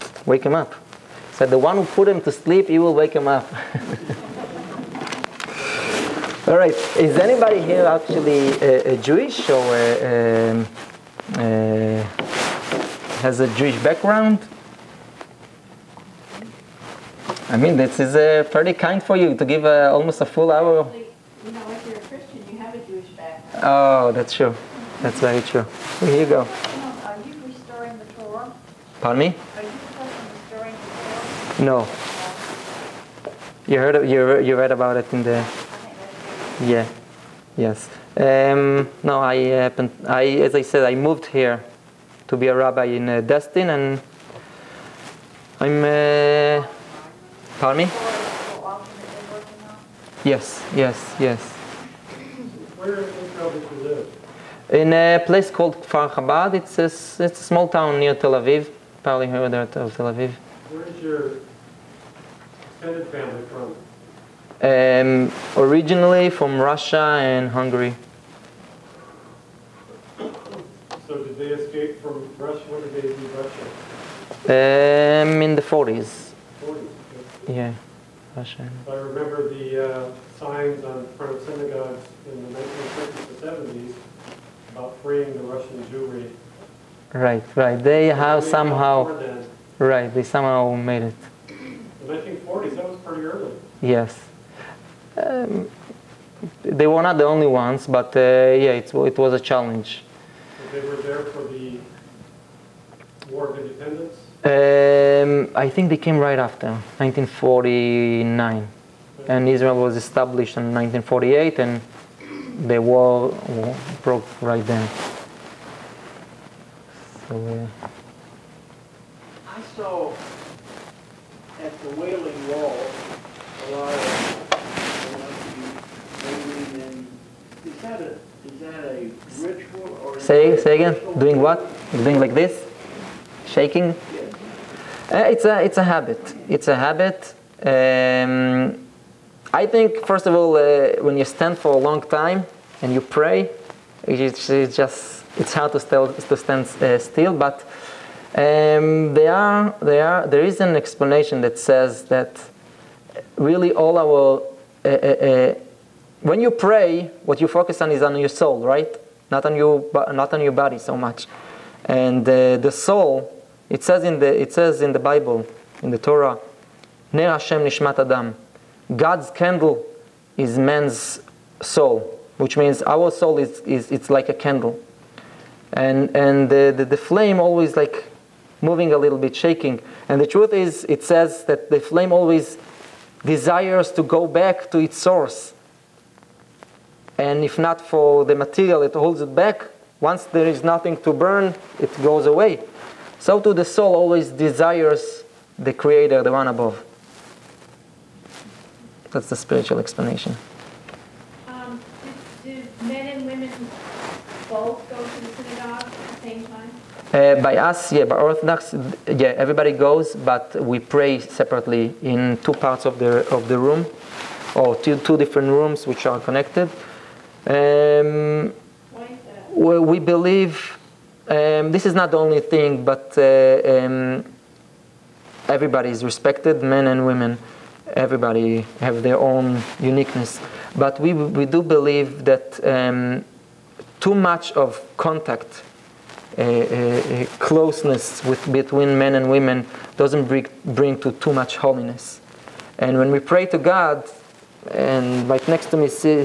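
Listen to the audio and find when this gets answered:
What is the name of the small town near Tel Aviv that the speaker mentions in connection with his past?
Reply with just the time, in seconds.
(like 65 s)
55 s.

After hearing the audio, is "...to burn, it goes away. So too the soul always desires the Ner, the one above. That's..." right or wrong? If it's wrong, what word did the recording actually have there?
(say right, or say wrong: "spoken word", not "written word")
wrong: "Creator", not "Ner".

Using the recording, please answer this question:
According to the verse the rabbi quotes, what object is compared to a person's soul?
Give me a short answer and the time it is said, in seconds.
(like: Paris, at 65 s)
God's candle, at 168 s.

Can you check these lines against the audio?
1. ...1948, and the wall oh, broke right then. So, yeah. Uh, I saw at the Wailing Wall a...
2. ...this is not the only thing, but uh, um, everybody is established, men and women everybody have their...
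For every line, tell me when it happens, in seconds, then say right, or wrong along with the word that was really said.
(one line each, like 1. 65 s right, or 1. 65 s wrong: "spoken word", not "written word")
1. 110 s right
2. 221 s wrong: "respected", not "established".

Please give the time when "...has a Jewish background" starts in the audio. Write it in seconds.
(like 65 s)
13 s.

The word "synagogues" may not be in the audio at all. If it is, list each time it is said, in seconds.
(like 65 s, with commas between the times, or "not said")
81 s, 205 s.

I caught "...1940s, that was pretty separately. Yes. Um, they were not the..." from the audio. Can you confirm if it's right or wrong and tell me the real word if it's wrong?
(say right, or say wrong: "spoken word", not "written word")
wrong: "early", not "separately".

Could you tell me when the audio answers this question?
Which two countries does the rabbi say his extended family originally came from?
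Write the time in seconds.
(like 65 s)
66 s.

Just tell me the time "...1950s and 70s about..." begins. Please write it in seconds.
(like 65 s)
82 s.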